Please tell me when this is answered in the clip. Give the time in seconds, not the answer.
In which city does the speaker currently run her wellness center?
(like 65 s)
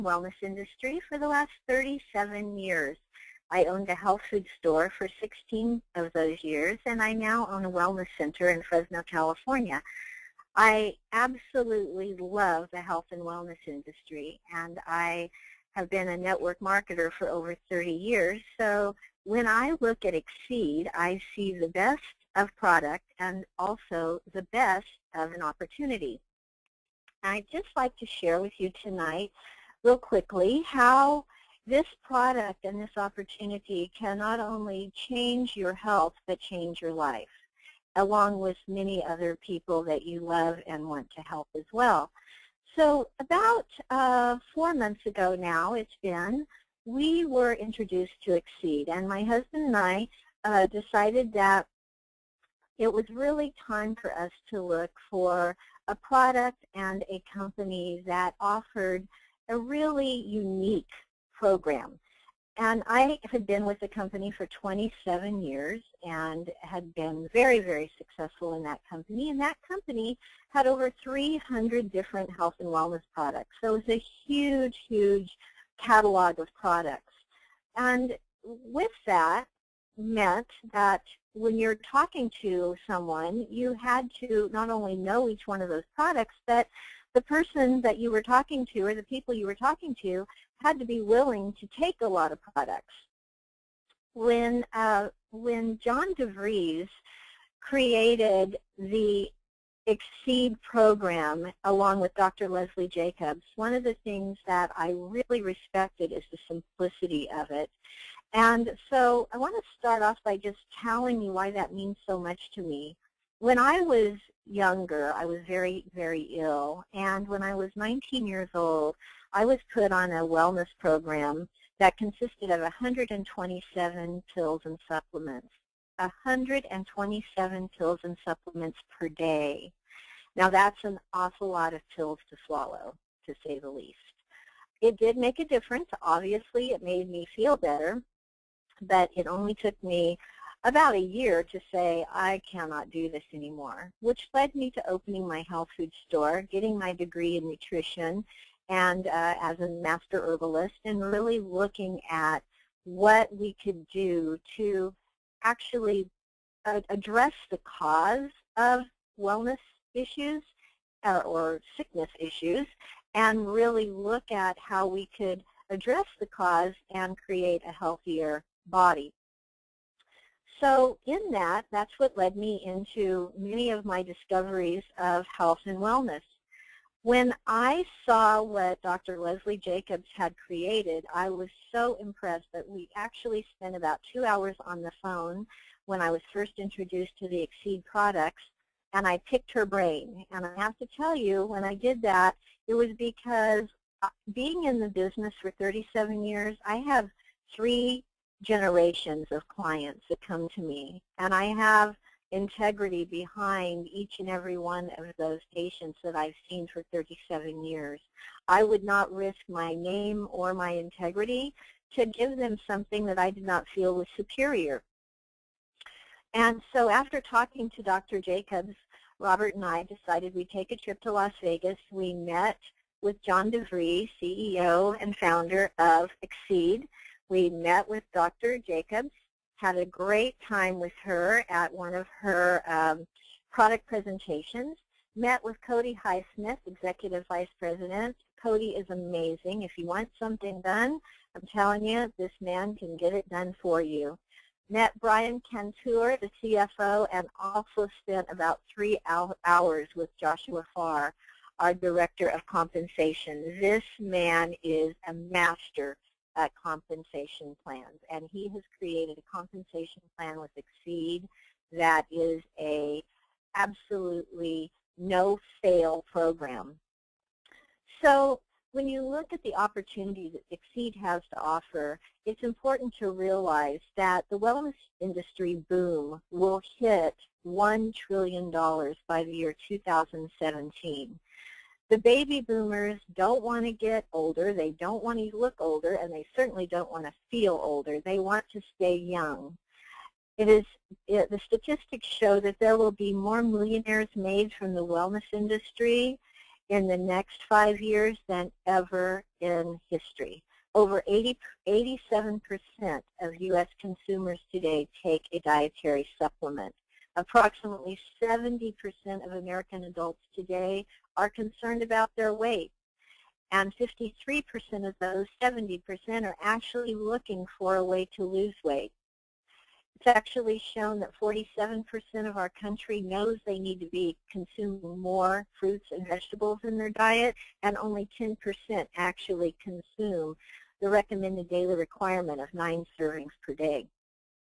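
8 s.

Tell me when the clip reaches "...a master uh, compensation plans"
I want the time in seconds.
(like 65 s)
255 s.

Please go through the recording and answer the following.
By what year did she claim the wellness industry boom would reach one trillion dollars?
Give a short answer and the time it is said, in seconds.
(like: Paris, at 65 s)
2017, at 279 s.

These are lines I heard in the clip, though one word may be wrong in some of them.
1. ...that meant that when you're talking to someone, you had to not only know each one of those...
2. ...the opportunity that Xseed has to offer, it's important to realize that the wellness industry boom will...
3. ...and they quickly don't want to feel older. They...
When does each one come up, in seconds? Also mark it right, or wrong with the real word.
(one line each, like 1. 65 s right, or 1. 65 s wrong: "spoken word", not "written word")
1. 79 s right
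2. 269 s right
3. 286 s wrong: "certainly", not "quickly".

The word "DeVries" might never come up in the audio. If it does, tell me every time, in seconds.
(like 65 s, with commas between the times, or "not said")
96 s, 223 s.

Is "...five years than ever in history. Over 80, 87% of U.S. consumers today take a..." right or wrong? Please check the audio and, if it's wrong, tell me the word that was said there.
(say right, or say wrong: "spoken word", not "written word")
right.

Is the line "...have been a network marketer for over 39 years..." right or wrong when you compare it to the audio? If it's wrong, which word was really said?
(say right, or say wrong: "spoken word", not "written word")
wrong: "30", not "39".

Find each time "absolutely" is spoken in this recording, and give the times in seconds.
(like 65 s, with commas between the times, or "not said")
11 s, 263 s.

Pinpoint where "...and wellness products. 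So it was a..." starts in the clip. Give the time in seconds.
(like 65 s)
72 s.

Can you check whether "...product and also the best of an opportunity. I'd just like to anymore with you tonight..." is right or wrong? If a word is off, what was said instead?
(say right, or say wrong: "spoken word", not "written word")
wrong: "share", not "anymore".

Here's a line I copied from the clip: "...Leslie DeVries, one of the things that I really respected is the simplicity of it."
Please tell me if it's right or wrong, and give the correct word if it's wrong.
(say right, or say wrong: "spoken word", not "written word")
wrong: "Jacobs", not "DeVries".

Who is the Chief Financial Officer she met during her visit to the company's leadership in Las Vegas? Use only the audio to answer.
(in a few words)
Brian Cantor.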